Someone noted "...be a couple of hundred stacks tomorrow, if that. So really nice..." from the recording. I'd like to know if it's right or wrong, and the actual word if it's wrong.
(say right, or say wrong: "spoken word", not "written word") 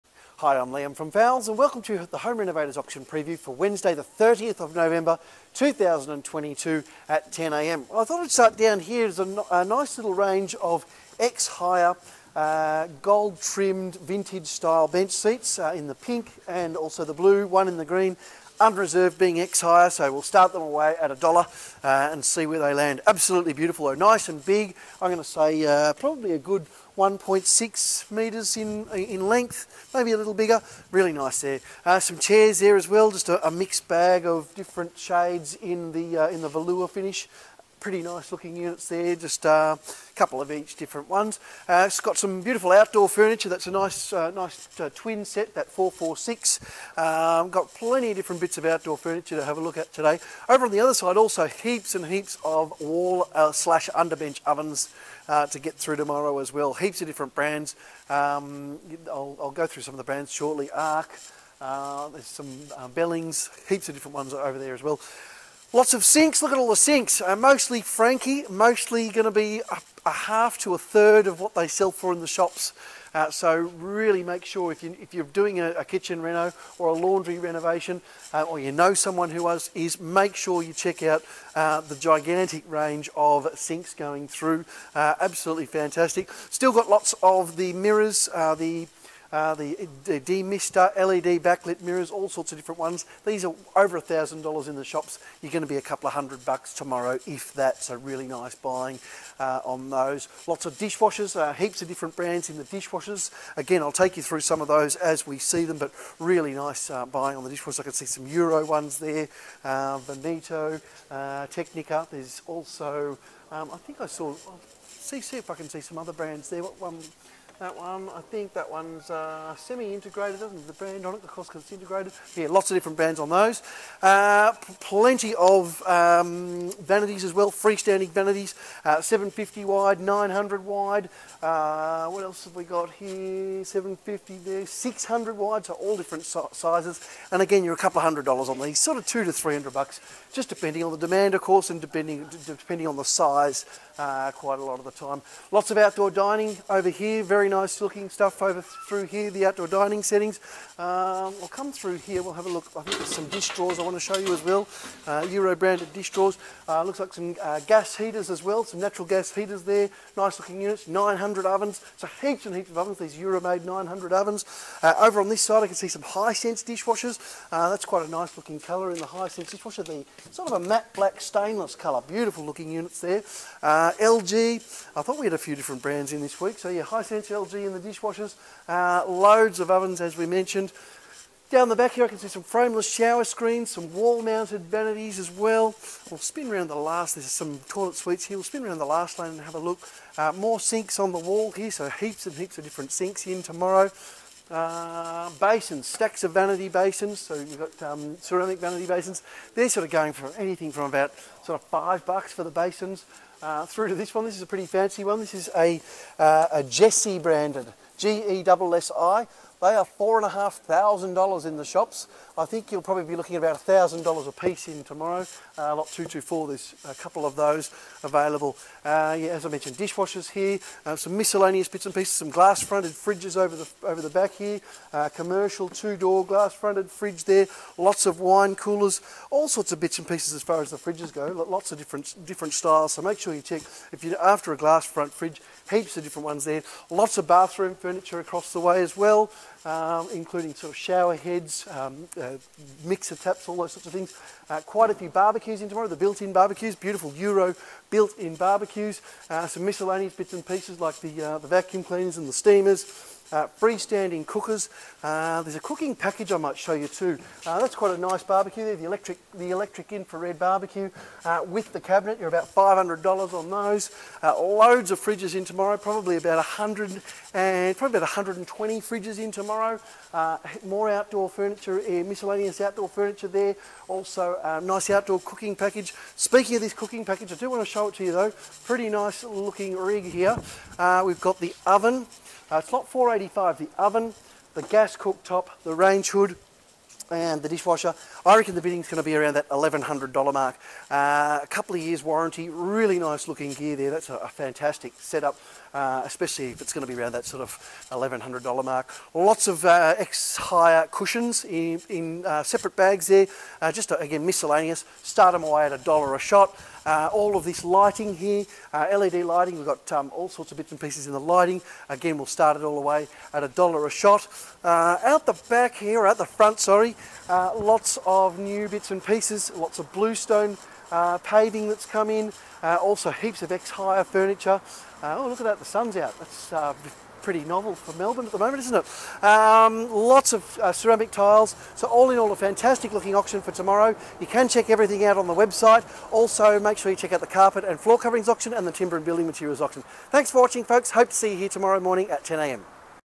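wrong: "bucks", not "stacks".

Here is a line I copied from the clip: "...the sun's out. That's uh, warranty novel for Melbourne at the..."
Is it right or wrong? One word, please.
wrong.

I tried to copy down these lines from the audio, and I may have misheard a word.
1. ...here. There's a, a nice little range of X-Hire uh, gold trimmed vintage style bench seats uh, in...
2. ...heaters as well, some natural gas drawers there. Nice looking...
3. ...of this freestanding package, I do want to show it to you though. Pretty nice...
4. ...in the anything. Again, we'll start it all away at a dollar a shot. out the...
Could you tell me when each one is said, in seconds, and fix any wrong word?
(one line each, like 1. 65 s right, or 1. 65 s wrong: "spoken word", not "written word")
1. 8 s right
2. 157 s wrong: "heaters", not "drawers"
3. 276 s wrong: "cooking", not "freestanding"
4. 311 s wrong: "lighting", not "anything".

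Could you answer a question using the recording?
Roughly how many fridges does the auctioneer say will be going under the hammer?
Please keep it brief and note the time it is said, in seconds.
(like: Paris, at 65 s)
120, at 268 s.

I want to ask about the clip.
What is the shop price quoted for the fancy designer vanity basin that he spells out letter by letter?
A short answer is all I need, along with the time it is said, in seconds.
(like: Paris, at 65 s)
$4,500, at 209 s.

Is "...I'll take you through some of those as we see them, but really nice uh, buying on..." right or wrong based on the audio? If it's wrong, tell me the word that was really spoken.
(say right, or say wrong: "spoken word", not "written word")
right.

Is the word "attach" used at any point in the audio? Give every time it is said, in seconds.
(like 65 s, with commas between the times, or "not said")
not said.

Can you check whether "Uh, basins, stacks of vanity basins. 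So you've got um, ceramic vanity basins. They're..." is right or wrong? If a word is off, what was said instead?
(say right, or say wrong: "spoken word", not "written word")
right.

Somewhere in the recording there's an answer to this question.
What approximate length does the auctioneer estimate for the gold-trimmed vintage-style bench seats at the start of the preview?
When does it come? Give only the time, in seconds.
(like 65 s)
26 s.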